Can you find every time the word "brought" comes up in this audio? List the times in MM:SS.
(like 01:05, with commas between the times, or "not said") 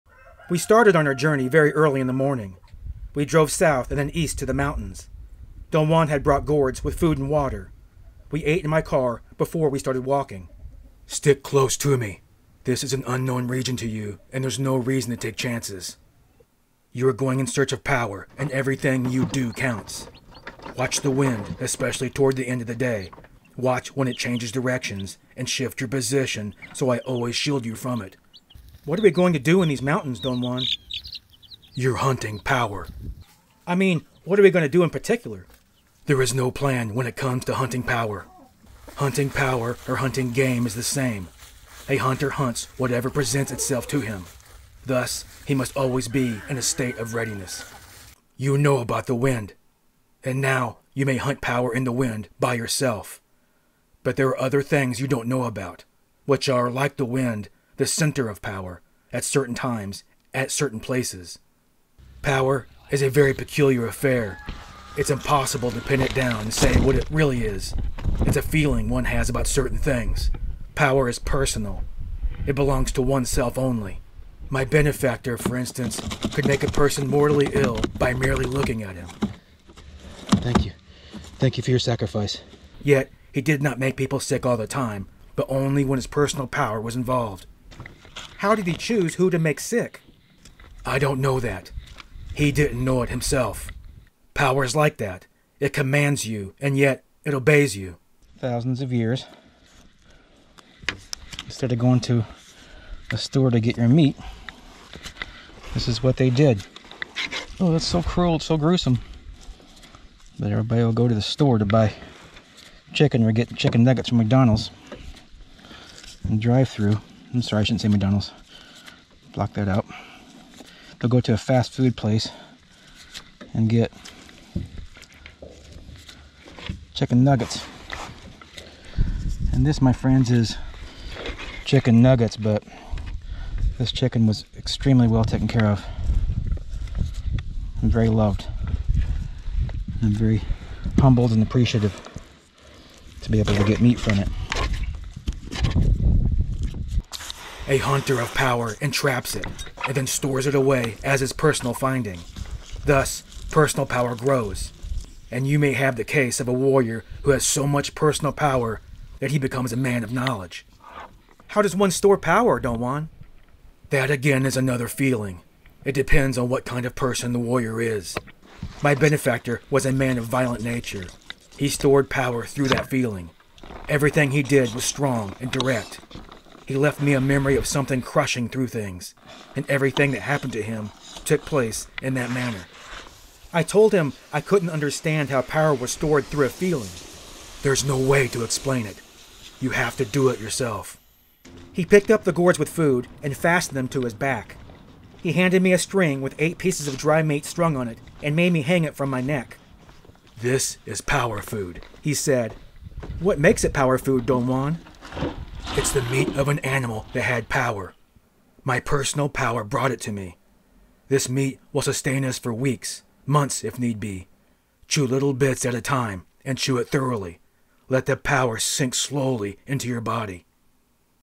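00:06, 03:29.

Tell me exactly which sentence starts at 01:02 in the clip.
Power is a very peculiar affair.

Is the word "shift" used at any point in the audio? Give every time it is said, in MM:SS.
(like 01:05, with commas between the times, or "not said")
00:25.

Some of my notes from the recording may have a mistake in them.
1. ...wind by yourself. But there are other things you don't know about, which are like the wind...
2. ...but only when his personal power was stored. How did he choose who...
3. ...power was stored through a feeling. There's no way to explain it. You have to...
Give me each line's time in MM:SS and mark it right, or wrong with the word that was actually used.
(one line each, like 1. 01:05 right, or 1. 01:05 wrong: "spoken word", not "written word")
1. 00:51 right
2. 01:25 wrong: "involved", not "stored"
3. 03:05 right.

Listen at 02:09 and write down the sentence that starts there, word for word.
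And this, my friends, is chicken nuggets, but this chicken was extremely well taken care of.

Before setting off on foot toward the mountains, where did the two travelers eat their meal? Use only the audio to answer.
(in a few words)
In my car.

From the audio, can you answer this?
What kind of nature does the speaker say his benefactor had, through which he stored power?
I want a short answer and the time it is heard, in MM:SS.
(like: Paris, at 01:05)
Violent, at 02:50.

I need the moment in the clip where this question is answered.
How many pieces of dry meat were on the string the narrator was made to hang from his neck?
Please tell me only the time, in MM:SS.
03:16.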